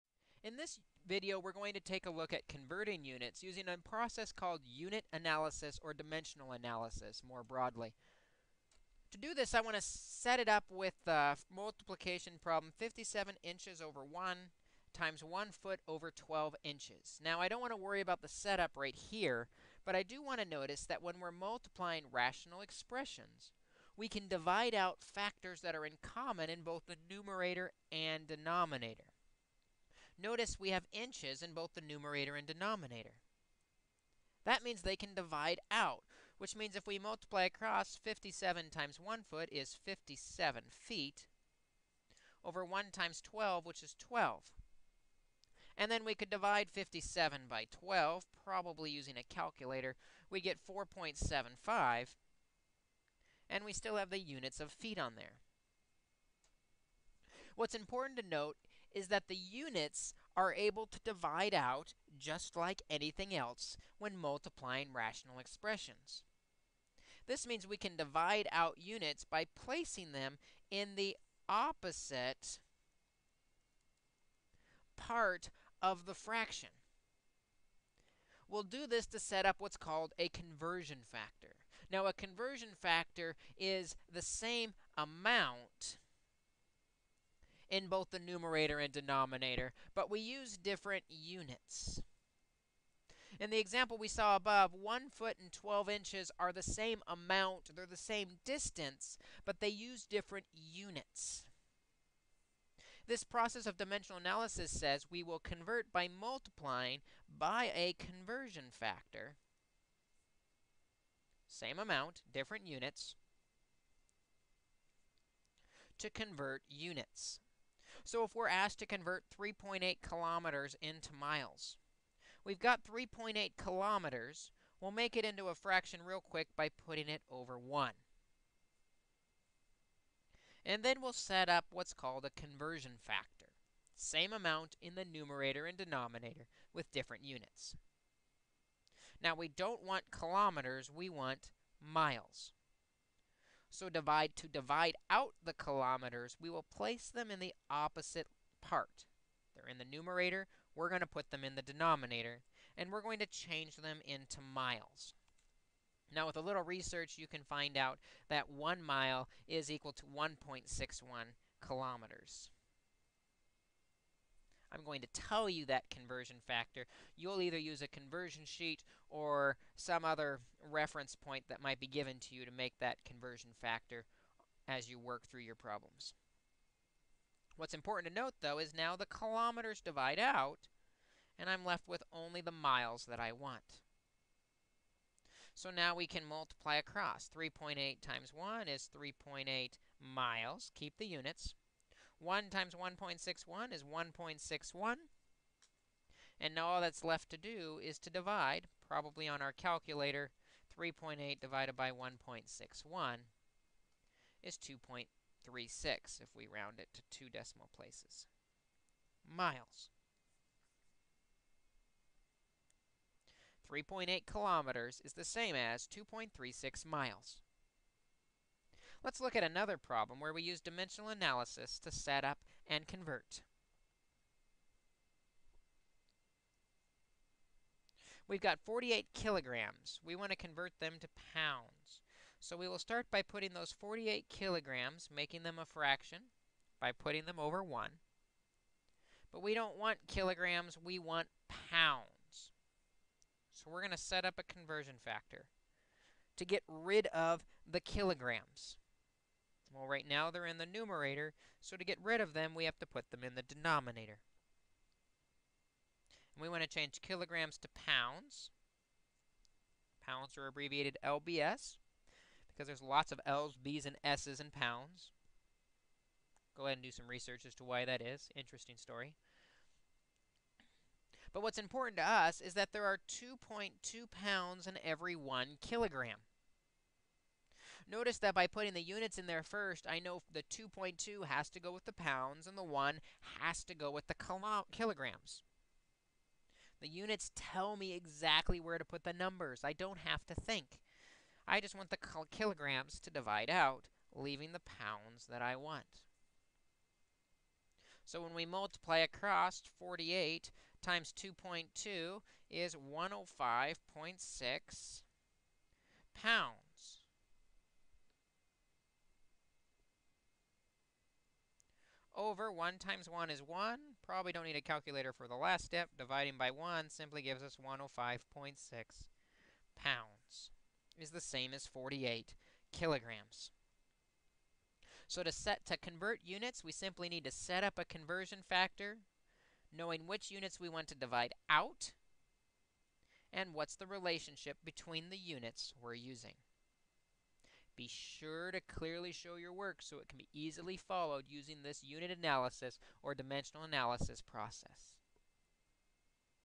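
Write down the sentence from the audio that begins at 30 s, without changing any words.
Notice we have inches in both the numerator and denominator.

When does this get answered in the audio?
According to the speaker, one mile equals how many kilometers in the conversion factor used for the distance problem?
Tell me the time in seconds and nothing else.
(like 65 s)
160 s.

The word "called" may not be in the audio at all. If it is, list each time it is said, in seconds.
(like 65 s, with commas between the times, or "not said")
4 s, 79 s, 131 s.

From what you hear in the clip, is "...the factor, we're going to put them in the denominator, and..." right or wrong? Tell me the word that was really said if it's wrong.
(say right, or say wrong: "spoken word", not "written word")
wrong: "numerator", not "factor".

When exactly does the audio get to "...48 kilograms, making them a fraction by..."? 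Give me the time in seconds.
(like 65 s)
233 s.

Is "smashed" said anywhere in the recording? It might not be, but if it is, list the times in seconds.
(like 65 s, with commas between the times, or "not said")
not said.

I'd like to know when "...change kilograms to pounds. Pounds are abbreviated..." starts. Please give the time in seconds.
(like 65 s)
256 s.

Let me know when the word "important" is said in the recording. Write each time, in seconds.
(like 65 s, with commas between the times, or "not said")
57 s, 177 s, 271 s.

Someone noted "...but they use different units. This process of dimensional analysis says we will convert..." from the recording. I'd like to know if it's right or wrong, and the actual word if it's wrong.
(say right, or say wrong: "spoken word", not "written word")
right.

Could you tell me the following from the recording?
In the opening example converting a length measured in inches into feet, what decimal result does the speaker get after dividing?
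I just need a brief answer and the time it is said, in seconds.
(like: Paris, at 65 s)
4.75, at 50 s.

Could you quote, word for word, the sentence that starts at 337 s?
Be sure to clearly show your work so it can be easily followed using this unit analysis or dimensional analysis process.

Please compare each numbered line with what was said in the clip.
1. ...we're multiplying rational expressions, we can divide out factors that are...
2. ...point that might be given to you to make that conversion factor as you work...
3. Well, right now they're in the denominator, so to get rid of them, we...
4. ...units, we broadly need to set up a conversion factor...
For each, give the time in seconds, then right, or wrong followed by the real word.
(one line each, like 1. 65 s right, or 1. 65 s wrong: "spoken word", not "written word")
1. 21 s right
2. 171 s right
3. 249 s wrong: "numerator", not "denominator"
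4. 326 s wrong: "simply", not "broadly".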